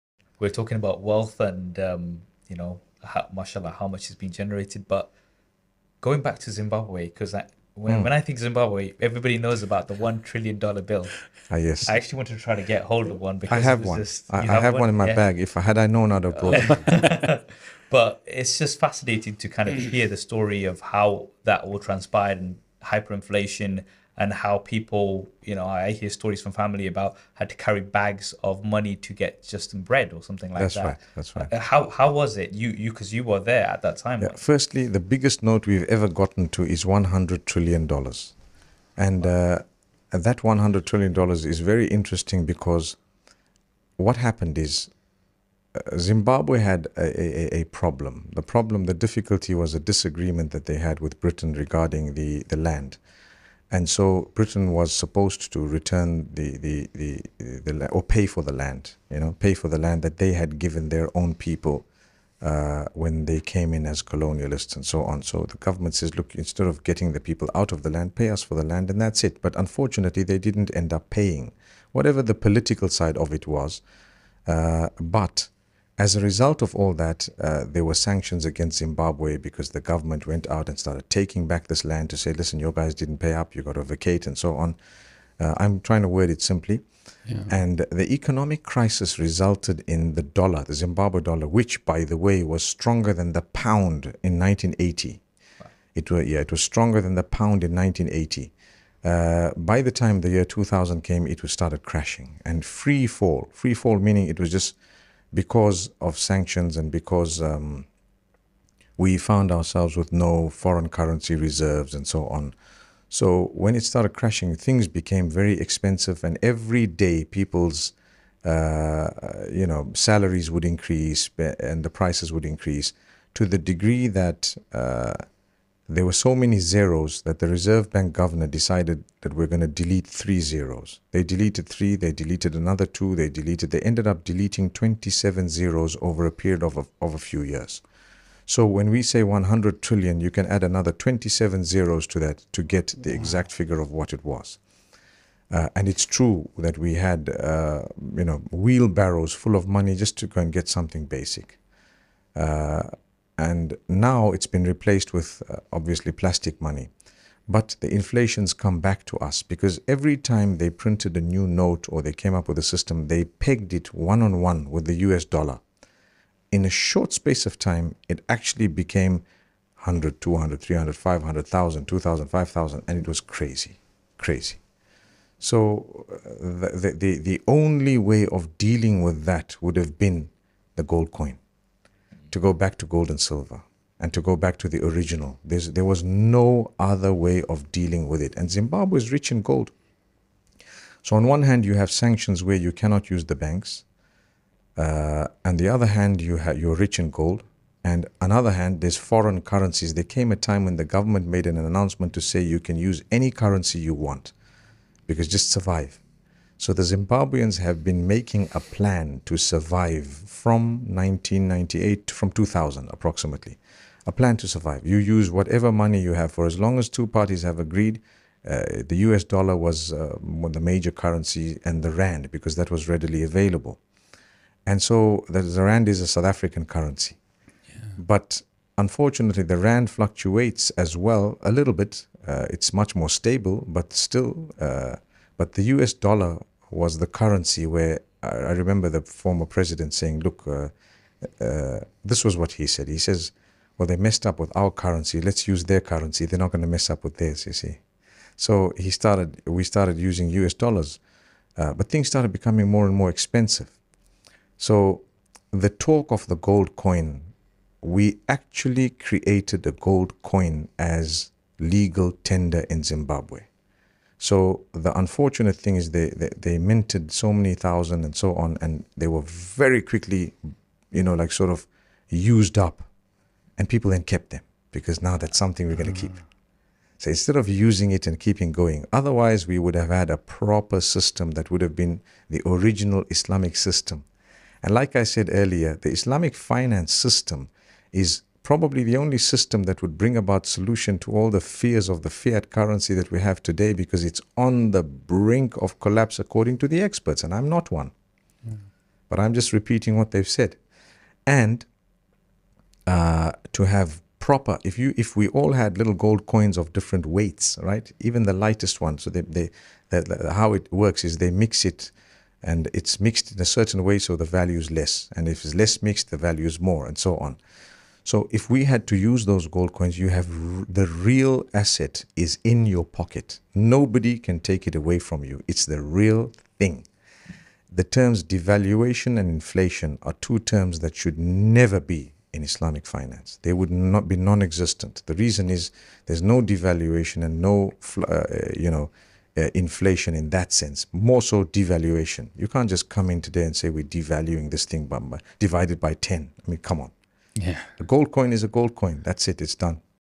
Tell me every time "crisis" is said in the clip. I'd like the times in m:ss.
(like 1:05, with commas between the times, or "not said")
1:28.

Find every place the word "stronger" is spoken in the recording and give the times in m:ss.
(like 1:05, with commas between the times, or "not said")
1:32, 1:36.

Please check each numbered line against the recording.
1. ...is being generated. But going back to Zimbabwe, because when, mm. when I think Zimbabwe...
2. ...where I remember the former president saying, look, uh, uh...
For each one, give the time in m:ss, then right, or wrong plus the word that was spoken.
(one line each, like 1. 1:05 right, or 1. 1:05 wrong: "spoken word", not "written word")
1. 0:04 right
2. 3:57 right.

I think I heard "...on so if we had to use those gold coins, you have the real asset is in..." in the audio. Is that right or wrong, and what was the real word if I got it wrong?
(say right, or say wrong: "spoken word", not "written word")
right.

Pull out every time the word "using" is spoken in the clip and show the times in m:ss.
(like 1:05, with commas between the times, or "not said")
4:09, 4:37.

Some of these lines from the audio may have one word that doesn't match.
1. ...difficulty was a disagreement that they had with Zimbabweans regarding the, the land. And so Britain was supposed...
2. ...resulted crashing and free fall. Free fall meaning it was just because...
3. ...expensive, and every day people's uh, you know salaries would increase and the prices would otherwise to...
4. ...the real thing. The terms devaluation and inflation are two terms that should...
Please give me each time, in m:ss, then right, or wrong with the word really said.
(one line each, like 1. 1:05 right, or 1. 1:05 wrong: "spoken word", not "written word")
1. 0:49 wrong: "Britain", not "Zimbabweans"
2. 1:41 wrong: "started", not "resulted"
3. 1:55 wrong: "increase", not "otherwise"
4. 5:25 right.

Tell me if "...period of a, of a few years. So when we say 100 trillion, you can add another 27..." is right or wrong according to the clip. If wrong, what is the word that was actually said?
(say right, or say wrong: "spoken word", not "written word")
right.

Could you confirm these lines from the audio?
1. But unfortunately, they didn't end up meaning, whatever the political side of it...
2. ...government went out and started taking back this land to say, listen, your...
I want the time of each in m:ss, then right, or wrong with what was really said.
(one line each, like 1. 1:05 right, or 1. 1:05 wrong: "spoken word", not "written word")
1. 1:09 wrong: "paying", not "meaning"
2. 1:19 right.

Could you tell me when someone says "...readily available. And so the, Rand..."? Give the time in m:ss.
3:42.